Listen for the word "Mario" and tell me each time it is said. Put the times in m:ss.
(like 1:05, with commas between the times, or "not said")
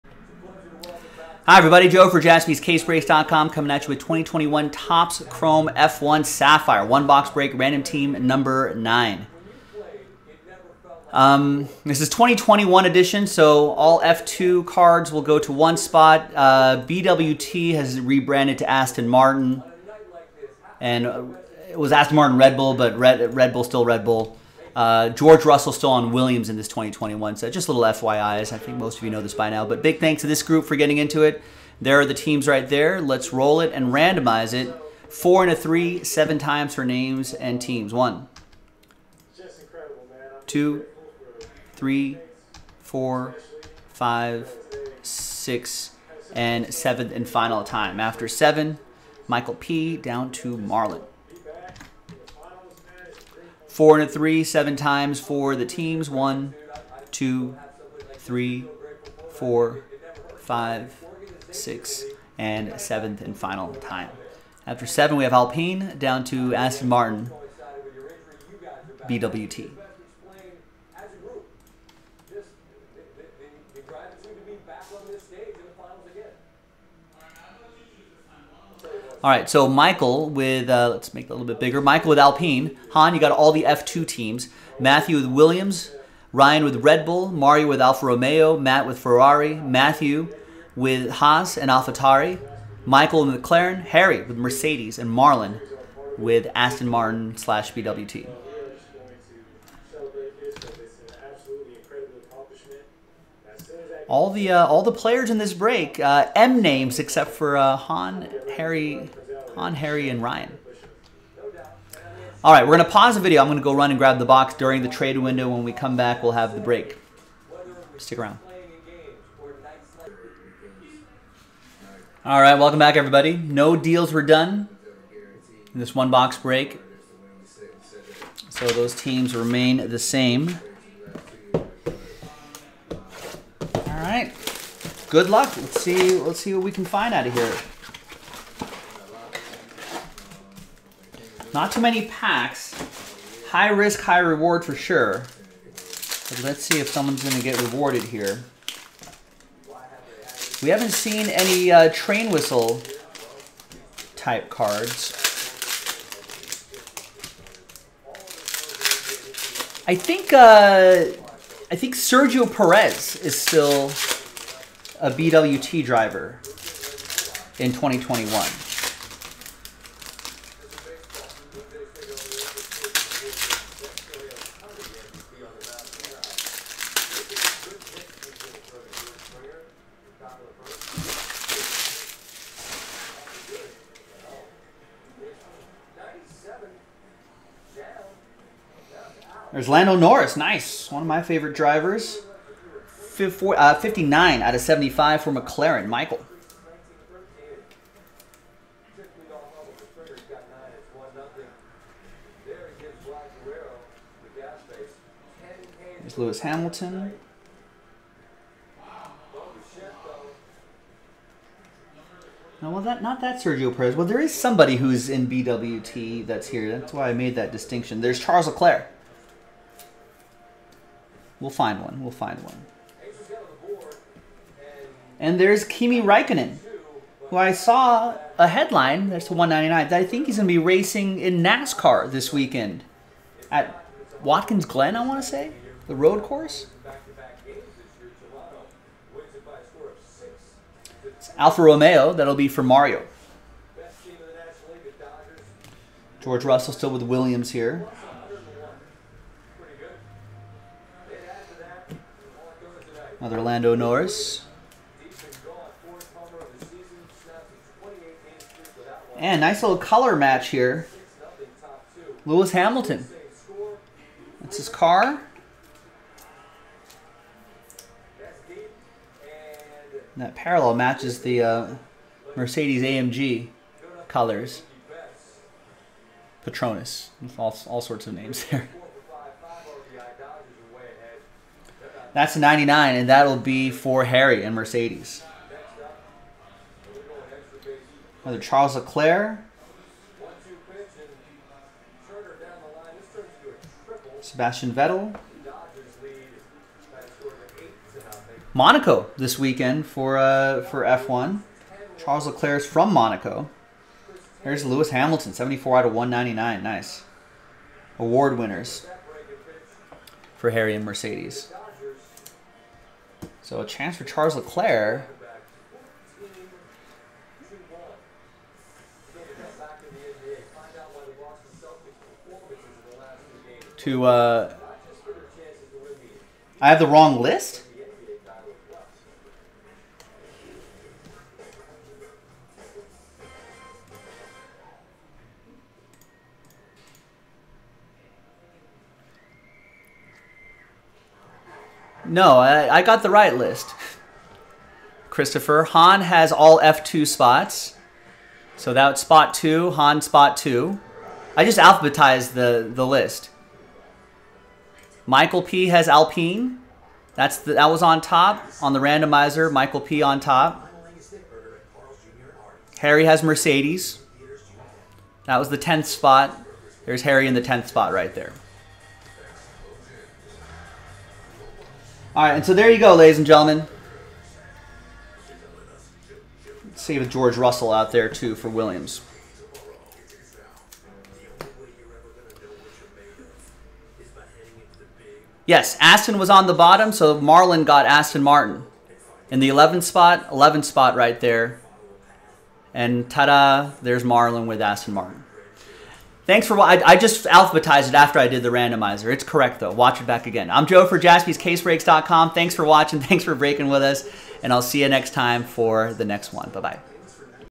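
1:27, 4:02.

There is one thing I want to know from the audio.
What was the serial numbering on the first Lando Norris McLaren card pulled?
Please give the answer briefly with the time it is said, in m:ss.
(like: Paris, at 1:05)
59/75, at 3:13.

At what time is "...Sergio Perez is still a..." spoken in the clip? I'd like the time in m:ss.
2:41.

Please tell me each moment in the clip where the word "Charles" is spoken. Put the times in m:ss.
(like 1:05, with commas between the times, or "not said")
3:38, 4:48, 5:01, 5:14.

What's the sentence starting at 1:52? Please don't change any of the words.
All right, we're gonna pause the video.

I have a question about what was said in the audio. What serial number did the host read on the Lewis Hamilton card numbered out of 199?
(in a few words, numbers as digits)
74.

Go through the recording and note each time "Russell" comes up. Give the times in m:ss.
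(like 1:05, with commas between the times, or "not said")
0:25, 4:06, 6:17.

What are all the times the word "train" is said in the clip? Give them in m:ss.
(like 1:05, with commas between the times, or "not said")
2:31.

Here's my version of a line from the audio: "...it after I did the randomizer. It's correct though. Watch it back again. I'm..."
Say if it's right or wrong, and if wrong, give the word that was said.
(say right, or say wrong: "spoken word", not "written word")
right.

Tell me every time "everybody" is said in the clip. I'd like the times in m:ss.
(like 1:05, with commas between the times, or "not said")
0:01, 2:02.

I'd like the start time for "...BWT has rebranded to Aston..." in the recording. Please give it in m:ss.
0:16.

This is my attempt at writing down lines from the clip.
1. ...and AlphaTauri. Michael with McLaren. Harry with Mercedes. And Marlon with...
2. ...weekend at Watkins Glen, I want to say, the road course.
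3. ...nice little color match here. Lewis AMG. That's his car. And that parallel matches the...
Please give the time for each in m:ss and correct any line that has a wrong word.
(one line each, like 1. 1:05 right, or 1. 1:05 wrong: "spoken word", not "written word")
1. 1:31 right
2. 3:52 right
3. 4:19 wrong: "Hamilton", not "AMG".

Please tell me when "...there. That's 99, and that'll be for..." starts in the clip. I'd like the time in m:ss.
4:38.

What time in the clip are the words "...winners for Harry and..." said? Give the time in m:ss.
5:08.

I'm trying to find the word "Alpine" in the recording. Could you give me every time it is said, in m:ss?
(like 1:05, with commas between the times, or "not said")
1:05, 1:22, 5:55.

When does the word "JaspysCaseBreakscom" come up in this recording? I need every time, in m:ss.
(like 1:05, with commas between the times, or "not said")
0:02, 6:40.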